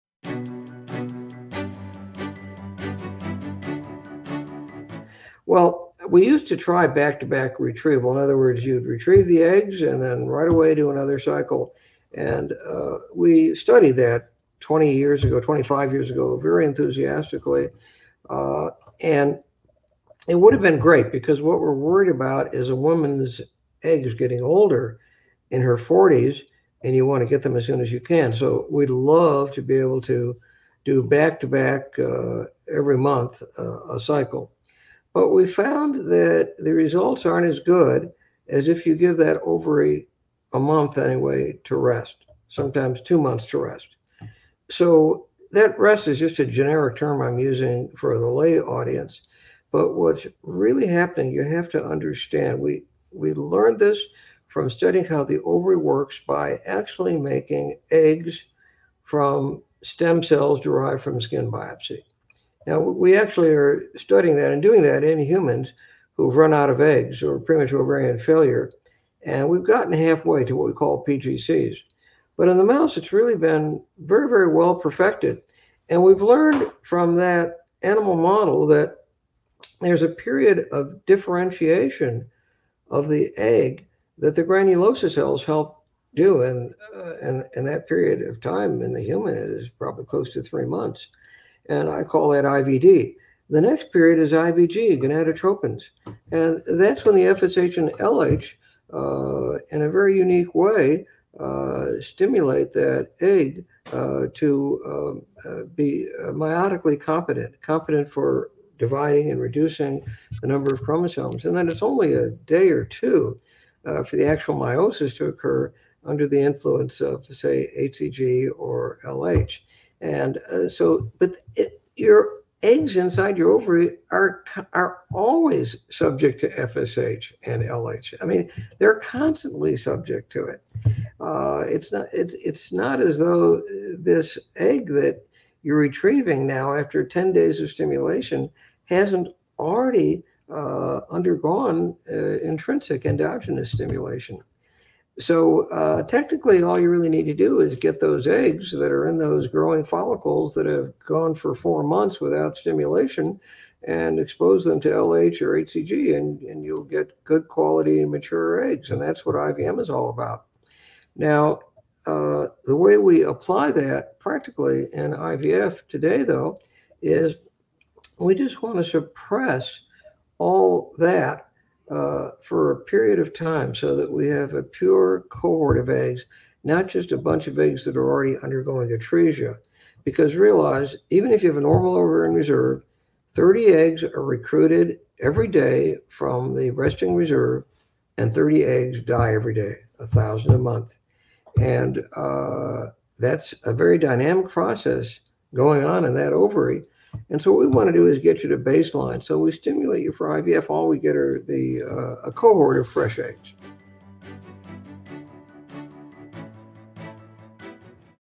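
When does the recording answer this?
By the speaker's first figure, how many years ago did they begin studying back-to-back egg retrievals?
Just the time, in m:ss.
0:14.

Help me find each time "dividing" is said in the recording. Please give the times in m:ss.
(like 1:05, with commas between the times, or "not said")
1:48.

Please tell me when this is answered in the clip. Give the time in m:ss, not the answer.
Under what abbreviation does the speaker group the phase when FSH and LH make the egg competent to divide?
1:34.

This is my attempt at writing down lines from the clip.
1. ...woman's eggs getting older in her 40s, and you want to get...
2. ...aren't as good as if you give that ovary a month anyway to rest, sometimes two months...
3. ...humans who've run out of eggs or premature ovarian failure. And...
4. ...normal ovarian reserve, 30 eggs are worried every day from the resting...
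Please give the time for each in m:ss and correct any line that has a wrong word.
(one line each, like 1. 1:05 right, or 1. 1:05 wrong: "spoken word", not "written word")
1. 0:22 right
2. 0:37 right
3. 1:05 right
4. 3:01 wrong: "recruited", not "worried".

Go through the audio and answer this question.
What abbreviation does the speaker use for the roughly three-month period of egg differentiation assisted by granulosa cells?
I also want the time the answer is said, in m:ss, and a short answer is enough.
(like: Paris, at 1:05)
IVD, at 1:32.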